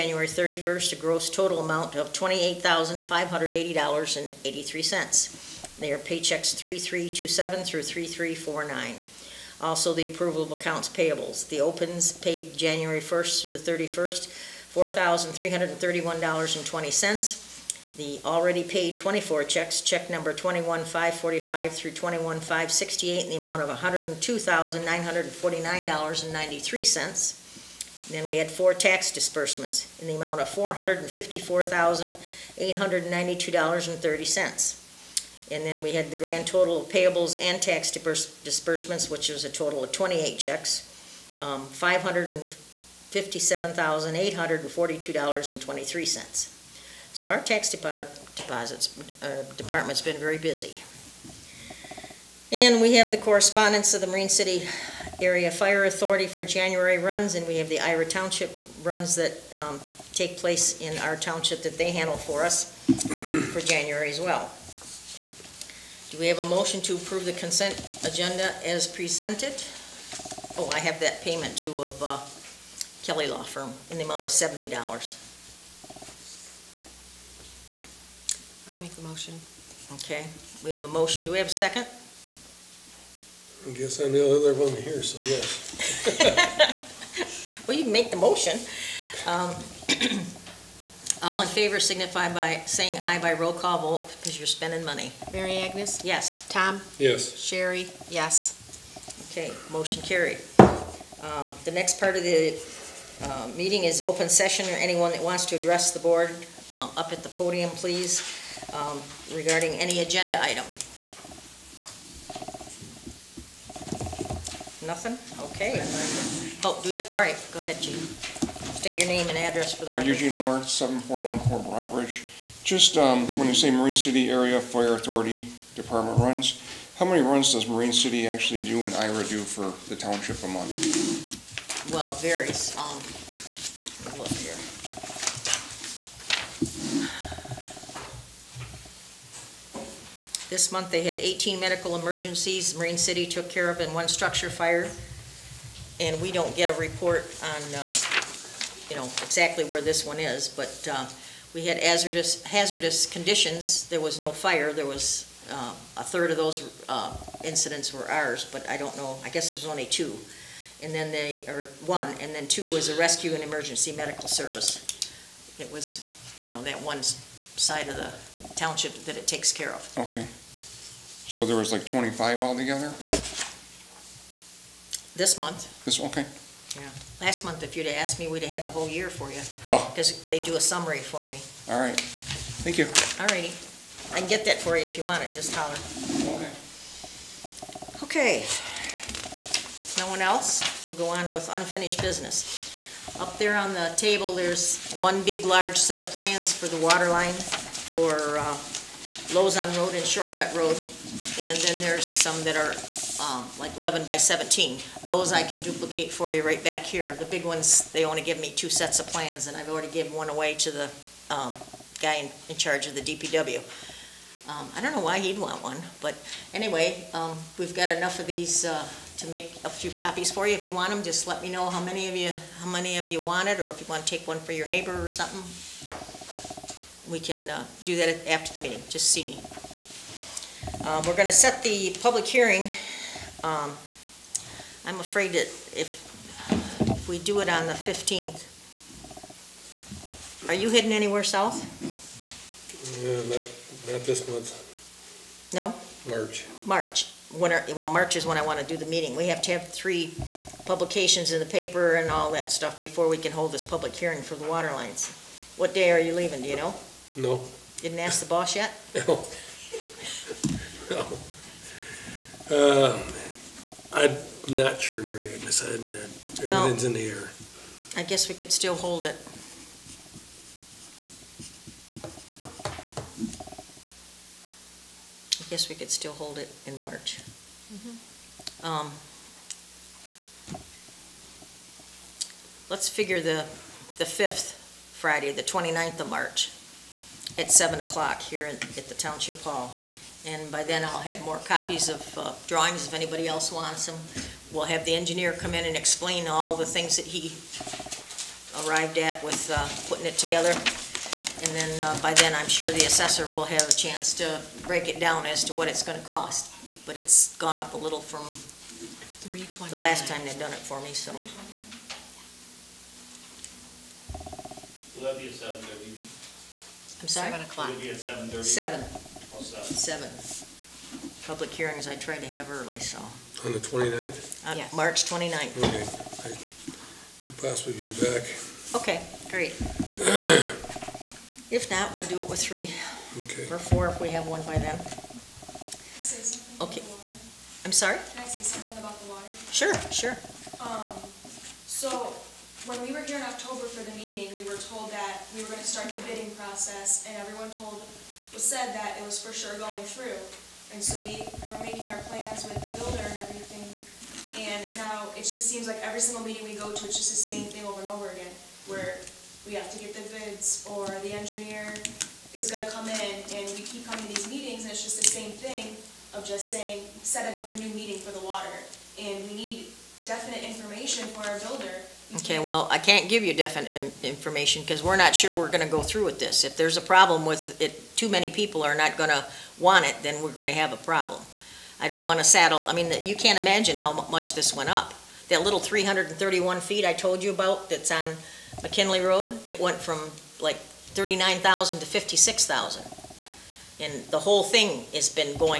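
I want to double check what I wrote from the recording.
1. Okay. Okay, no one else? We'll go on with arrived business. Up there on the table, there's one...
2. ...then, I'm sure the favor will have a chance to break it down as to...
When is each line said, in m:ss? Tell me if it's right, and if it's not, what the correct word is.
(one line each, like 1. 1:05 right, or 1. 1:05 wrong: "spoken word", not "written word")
1. 3:06 wrong: "unfinished", not "arrived"
2. 5:02 wrong: "assessor", not "favor".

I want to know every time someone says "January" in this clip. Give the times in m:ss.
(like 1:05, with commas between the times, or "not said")
0:12, 0:56, 1:03.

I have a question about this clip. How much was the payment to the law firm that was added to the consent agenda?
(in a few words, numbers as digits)
$70.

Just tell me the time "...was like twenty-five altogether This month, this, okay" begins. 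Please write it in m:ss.
2:51.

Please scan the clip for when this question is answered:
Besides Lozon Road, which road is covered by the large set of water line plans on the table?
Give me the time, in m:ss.
3:20.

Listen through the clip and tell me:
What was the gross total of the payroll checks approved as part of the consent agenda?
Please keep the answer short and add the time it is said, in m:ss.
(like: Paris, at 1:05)
$28,580.83, at 0:02.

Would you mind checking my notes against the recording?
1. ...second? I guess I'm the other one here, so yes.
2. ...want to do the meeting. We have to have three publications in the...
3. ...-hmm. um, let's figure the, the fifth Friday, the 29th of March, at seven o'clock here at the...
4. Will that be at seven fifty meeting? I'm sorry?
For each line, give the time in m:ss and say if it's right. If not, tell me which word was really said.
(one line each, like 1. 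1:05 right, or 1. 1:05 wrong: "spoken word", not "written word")
1. 1:21 right
2. 4:08 right
3. 4:37 right
4. 5:14 wrong: "thirty", not "fifty".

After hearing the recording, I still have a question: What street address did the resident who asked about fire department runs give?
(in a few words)
7414 Broadbridge.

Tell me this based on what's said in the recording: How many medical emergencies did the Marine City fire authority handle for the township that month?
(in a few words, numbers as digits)
18.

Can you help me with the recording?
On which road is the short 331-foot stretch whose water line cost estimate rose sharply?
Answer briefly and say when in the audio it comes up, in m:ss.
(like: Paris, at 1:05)
McKinley Road, at 6:28.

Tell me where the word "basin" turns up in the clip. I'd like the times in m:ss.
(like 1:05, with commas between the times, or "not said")
not said.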